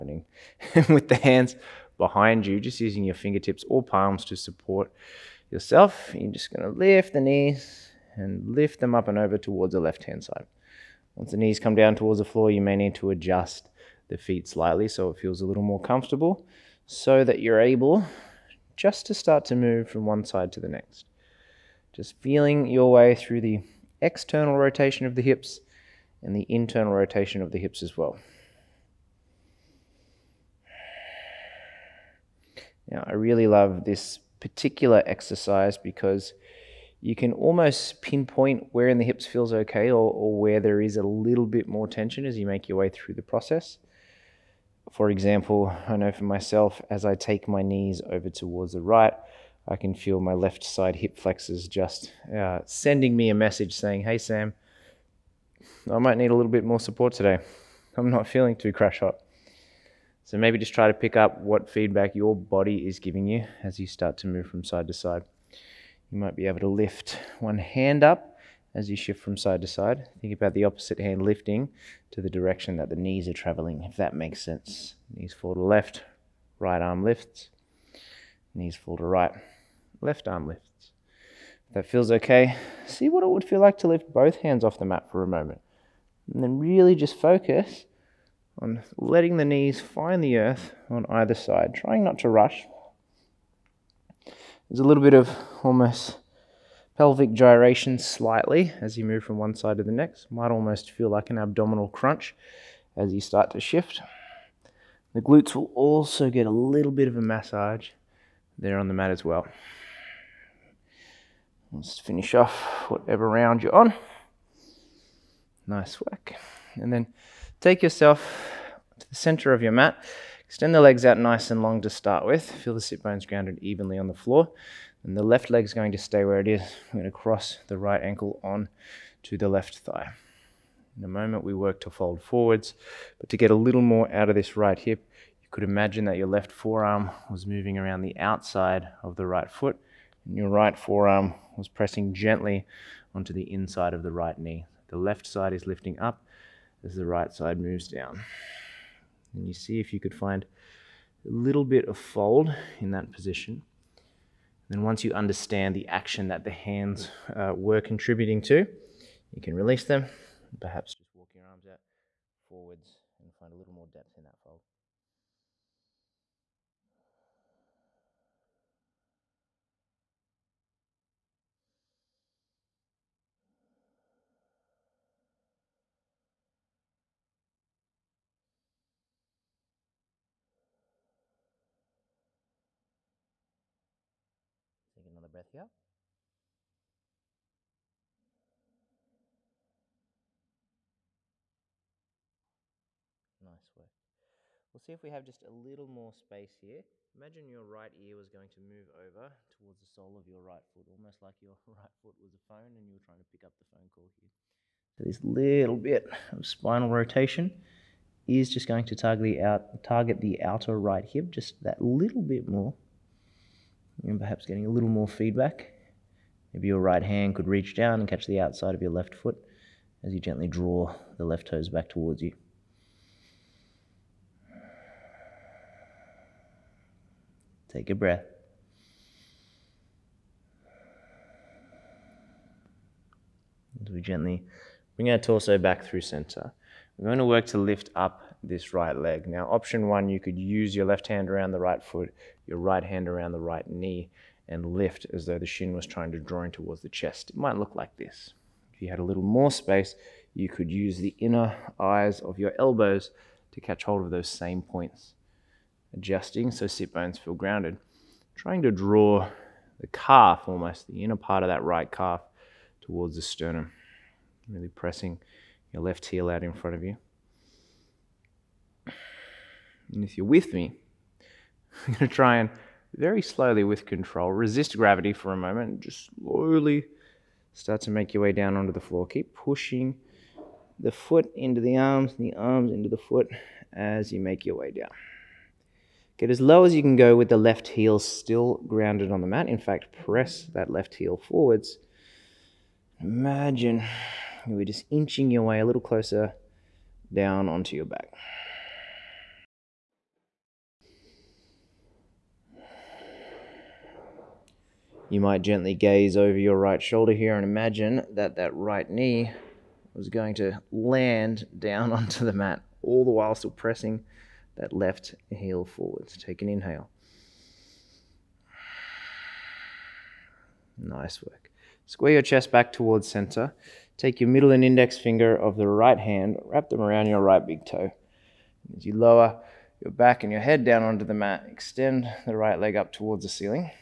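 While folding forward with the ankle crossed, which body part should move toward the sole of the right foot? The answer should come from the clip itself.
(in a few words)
Right ear.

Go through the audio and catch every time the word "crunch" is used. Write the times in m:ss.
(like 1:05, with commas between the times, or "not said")
1:41.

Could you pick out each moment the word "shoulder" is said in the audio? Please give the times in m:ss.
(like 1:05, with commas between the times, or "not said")
5:06.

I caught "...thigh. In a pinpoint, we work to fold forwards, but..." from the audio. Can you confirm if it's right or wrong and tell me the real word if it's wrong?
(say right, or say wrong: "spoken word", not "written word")
wrong: "moment", not "pinpoint".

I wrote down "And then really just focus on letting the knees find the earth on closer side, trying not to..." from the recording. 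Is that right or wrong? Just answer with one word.
wrong.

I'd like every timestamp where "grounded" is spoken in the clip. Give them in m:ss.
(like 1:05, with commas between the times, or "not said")
2:03, 4:17, 4:48.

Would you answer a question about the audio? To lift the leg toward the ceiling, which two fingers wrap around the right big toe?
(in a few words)
Middle and index finger.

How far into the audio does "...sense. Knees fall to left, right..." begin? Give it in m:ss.
1:14.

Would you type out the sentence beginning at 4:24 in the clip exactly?
Really pressing your left heel out in front of you.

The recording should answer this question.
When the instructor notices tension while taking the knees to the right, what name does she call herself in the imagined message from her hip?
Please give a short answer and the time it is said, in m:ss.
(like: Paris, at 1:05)
Sam, at 0:54.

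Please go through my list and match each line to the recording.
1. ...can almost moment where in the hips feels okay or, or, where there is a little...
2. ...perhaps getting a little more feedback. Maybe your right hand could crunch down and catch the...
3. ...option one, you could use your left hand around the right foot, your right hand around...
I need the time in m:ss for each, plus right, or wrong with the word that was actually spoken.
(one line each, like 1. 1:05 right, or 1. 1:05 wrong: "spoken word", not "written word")
1. 0:37 wrong: "pinpoint", not "moment"
2. 3:34 wrong: "reach", not "crunch"
3. 3:59 right.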